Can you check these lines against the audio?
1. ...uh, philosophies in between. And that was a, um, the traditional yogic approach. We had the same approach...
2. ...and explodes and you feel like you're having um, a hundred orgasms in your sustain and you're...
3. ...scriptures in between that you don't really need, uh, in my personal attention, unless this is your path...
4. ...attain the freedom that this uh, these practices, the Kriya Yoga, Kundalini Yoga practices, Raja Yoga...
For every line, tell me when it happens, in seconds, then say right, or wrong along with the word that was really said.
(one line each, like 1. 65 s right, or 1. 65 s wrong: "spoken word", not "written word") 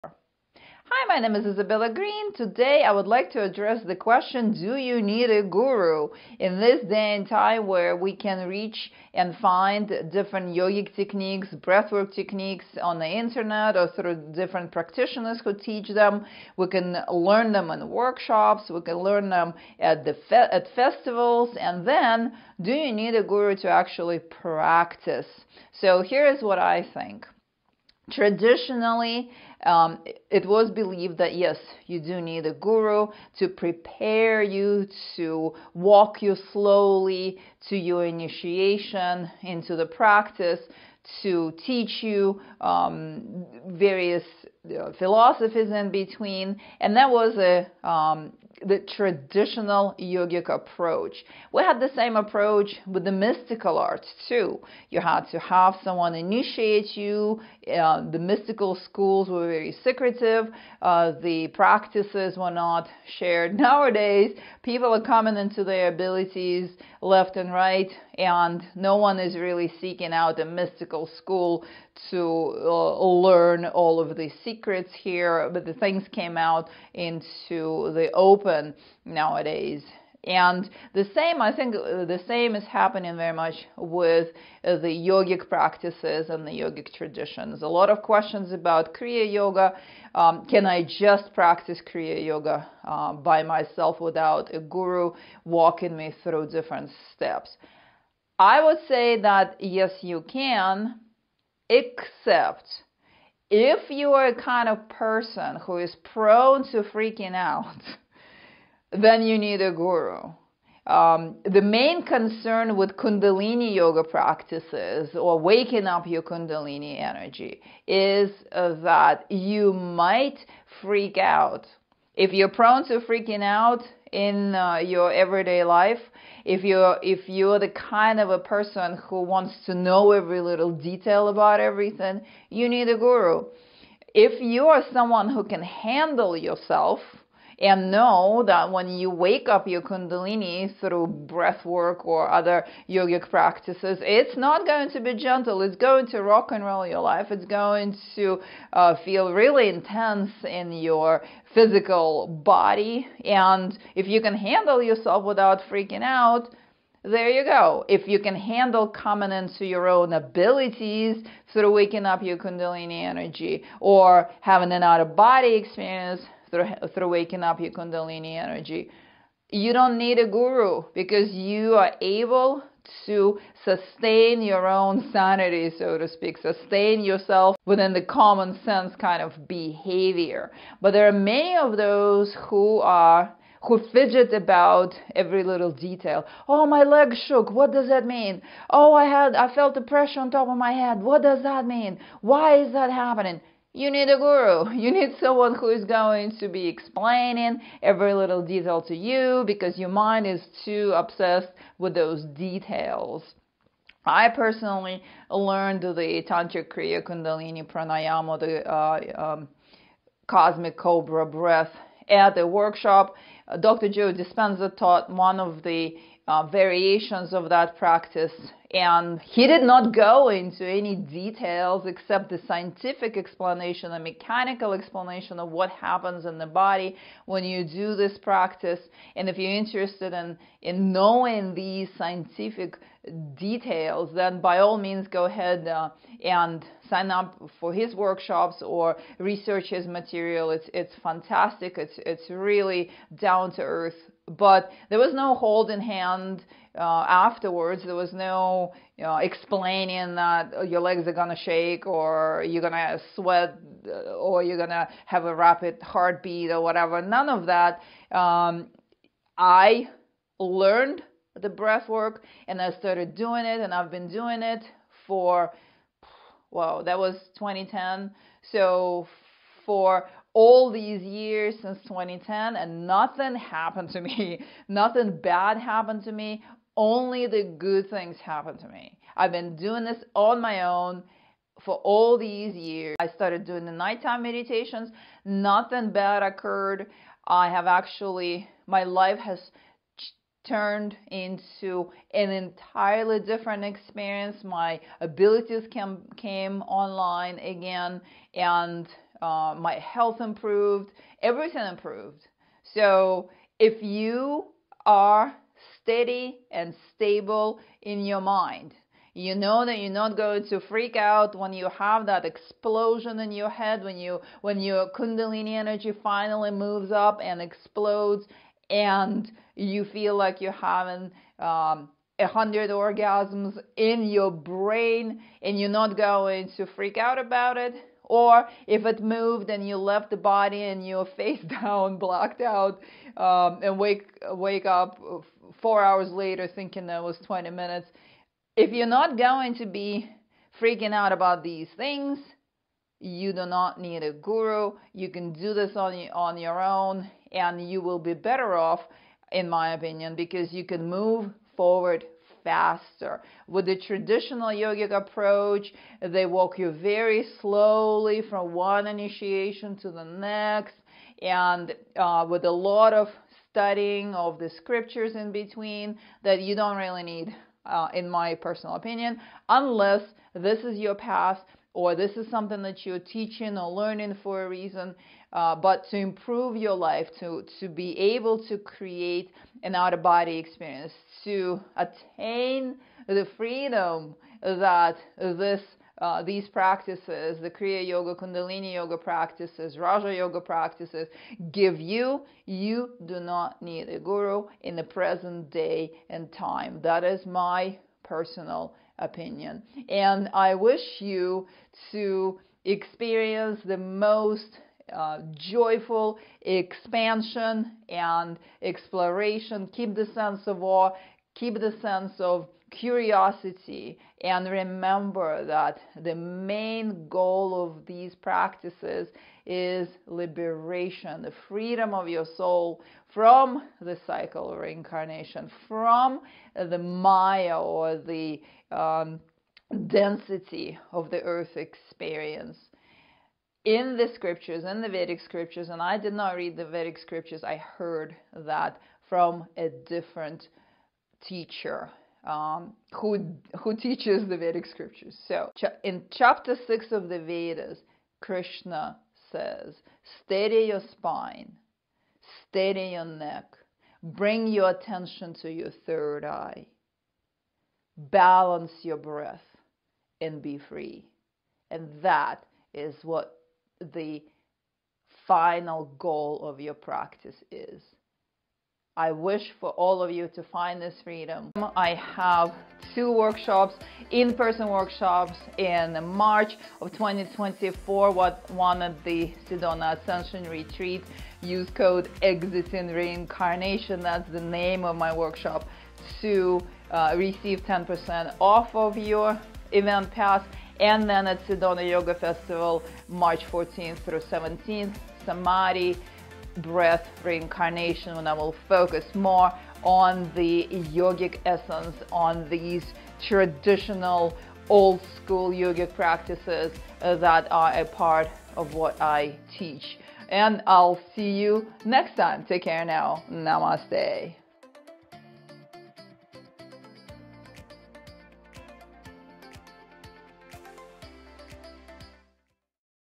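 1. 44 s right
2. 317 s wrong: "brain", not "sustain"
3. 364 s wrong: "opinion", not "attention"
4. 381 s right.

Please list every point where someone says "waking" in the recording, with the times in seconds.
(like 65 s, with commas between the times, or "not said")
115 s, 161 s, 167 s.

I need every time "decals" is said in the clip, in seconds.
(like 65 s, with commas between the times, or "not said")
not said.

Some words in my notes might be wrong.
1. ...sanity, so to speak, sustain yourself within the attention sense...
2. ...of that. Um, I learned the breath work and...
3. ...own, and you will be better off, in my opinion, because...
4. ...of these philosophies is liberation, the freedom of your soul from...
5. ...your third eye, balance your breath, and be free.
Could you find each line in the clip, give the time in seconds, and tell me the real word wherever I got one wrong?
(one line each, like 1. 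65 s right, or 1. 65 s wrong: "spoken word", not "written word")
1. 175 s wrong: "common", not "attention"
2. 257 s right
3. 346 s right
4. 417 s wrong: "practices", not "philosophies"
5. 455 s right.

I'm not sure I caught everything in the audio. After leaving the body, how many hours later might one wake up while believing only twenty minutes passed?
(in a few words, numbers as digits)
4.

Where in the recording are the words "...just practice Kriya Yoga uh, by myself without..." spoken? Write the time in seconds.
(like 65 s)
90 s.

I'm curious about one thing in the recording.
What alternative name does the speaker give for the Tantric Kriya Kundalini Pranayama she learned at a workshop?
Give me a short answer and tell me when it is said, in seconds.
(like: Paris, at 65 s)
cosmic cobra breath, at 210 s.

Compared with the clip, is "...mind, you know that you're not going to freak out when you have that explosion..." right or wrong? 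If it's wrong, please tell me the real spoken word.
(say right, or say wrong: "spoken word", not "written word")
right.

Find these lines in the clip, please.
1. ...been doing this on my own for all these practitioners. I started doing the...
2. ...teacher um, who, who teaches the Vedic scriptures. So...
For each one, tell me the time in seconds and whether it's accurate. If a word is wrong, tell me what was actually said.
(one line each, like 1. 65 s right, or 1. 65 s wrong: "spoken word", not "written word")
1. 279 s wrong: "years", not "practitioners"
2. 441 s right.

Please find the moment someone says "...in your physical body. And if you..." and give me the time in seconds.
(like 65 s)
150 s.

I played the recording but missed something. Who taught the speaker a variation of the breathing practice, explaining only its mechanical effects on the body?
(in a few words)
Dr. Joe Dispenza.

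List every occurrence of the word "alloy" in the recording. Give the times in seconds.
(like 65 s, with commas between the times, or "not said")
not said.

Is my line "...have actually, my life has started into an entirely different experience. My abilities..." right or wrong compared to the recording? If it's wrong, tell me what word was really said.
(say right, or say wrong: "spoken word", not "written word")
wrong: "turned", not "started".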